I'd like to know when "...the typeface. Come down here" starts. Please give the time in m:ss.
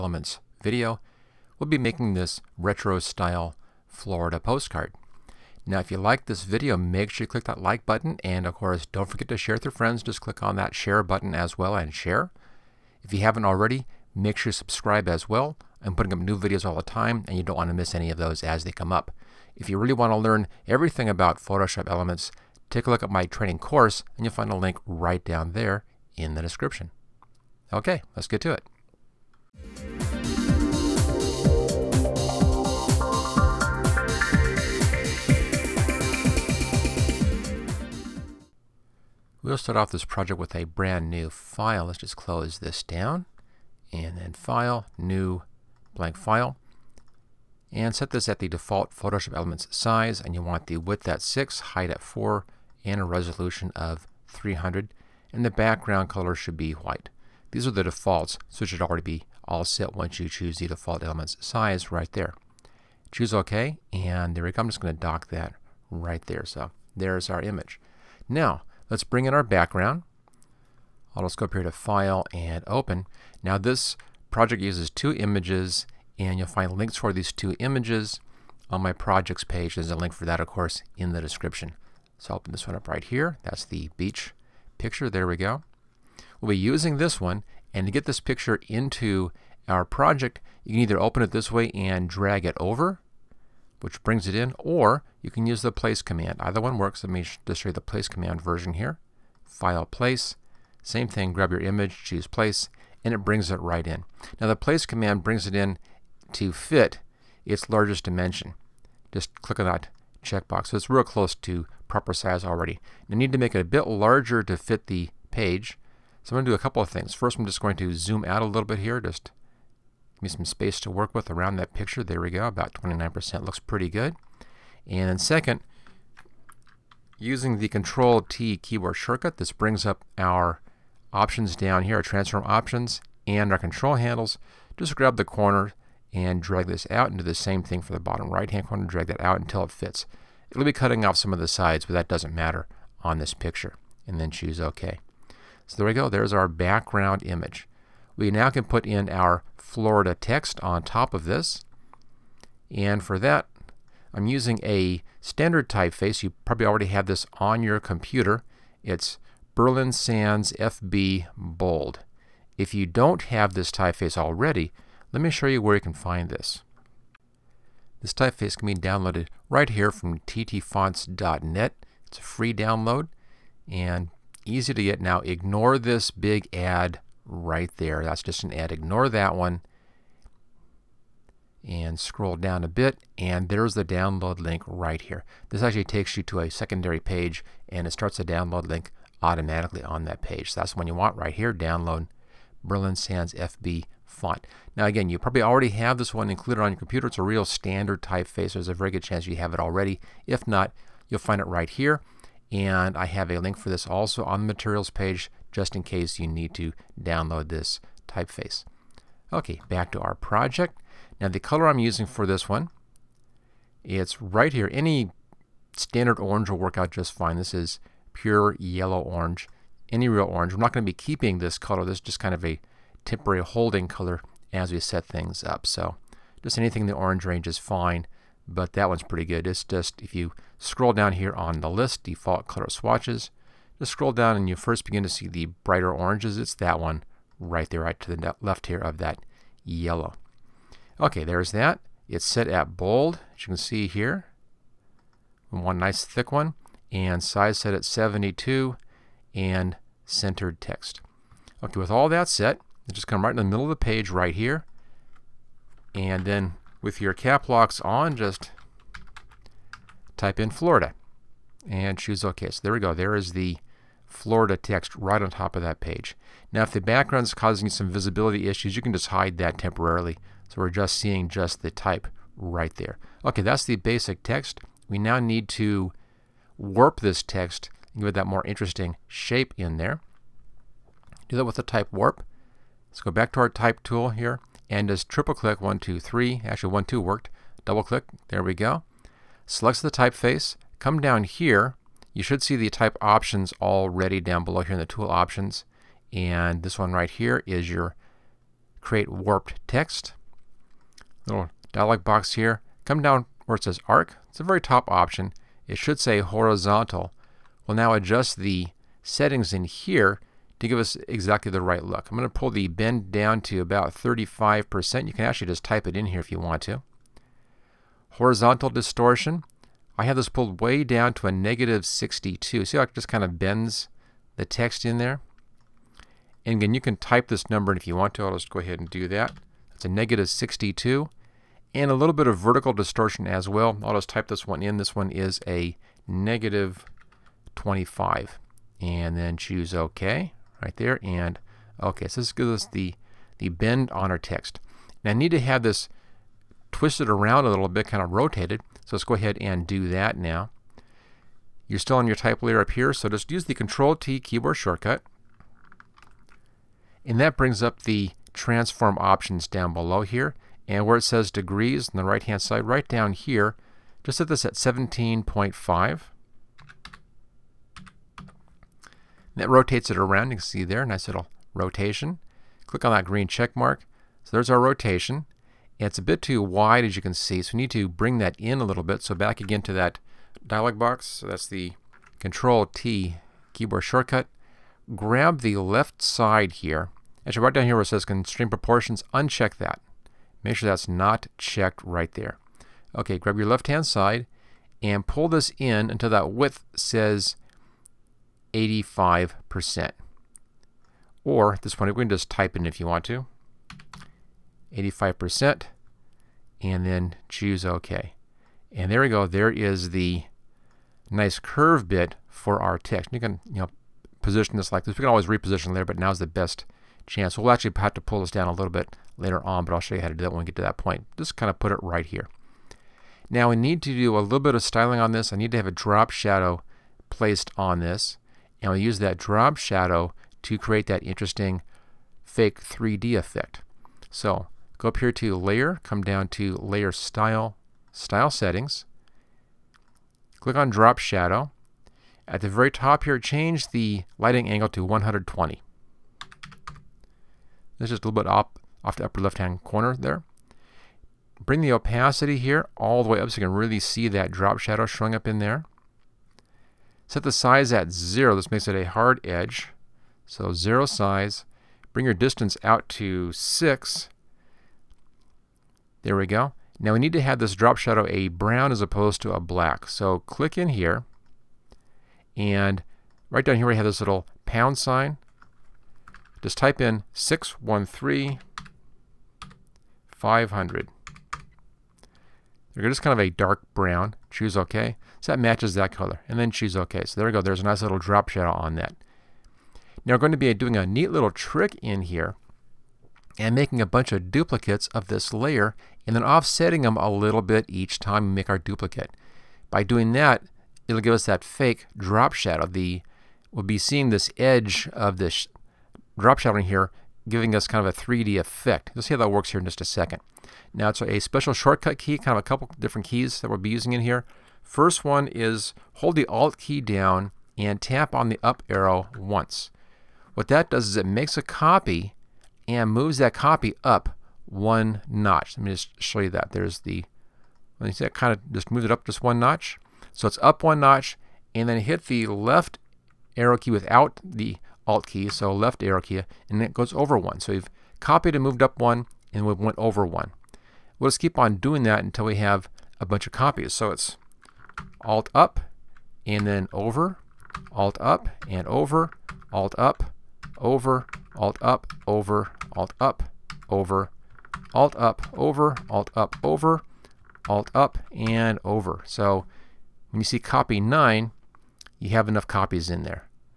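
4:49.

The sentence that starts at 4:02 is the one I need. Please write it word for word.
It's set at bold, as you can see here.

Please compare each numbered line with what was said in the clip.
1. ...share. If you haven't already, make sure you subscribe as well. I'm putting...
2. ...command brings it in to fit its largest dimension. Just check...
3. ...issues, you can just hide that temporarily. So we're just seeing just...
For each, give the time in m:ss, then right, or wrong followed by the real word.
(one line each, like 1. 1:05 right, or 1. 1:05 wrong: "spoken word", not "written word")
1. 0:11 right
2. 1:44 wrong: "click", not "check"
3. 4:28 right.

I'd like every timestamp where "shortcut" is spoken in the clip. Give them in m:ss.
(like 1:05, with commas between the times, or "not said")
2:08, 5:54, 6:23, 8:31.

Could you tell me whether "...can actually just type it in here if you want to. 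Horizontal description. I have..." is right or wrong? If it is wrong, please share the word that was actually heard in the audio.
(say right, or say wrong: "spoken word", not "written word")
wrong: "distortion", not "description".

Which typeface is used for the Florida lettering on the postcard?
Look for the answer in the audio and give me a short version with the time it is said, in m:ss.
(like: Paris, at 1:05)
Berlin Sans FB Bold, at 2:39.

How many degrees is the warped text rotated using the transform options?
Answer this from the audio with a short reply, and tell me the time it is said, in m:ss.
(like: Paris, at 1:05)
17.5, at 6:04.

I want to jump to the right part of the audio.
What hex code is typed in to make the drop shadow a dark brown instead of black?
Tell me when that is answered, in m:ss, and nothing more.
7:57.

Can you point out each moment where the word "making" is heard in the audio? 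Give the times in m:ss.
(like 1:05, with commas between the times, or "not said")
0:01, 8:13.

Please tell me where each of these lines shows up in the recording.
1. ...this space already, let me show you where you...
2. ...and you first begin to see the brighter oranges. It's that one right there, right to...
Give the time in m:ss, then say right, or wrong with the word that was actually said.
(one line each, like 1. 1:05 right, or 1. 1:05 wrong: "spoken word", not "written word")
1. 2:43 wrong: "typeface", not "space"
2. 3:54 right.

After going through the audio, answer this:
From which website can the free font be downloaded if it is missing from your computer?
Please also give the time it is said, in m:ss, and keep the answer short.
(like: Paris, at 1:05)
ttfonts.net, at 2:50.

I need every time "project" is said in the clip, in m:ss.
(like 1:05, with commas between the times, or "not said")
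0:40, 1:14, 1:18, 1:29, 3:30.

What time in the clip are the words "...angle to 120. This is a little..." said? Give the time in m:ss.
7:24.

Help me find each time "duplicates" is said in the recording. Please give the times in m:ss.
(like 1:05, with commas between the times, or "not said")
8:14, 8:18.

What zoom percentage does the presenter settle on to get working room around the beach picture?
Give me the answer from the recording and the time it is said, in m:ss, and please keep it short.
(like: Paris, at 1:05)
29%, at 2:02.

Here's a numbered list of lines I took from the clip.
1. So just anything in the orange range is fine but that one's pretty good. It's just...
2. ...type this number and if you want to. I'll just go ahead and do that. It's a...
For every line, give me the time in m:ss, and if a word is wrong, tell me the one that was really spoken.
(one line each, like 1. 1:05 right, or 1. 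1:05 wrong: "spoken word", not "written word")
1. 3:45 right
2. 5:26 right.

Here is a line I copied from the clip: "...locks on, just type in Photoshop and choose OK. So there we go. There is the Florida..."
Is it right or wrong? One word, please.
wrong.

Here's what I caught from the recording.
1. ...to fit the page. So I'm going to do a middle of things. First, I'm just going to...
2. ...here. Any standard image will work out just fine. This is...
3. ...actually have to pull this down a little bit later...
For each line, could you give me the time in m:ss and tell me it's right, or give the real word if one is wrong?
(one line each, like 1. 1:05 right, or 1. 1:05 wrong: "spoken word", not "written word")
1. 1:54 wrong: "couple", not "middle"
2. 3:34 wrong: "orange", not "image"
3. 6:57 right.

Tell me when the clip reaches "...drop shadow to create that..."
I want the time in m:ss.
7:09.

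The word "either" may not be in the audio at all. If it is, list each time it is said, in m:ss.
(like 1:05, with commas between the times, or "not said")
1:30, 1:36.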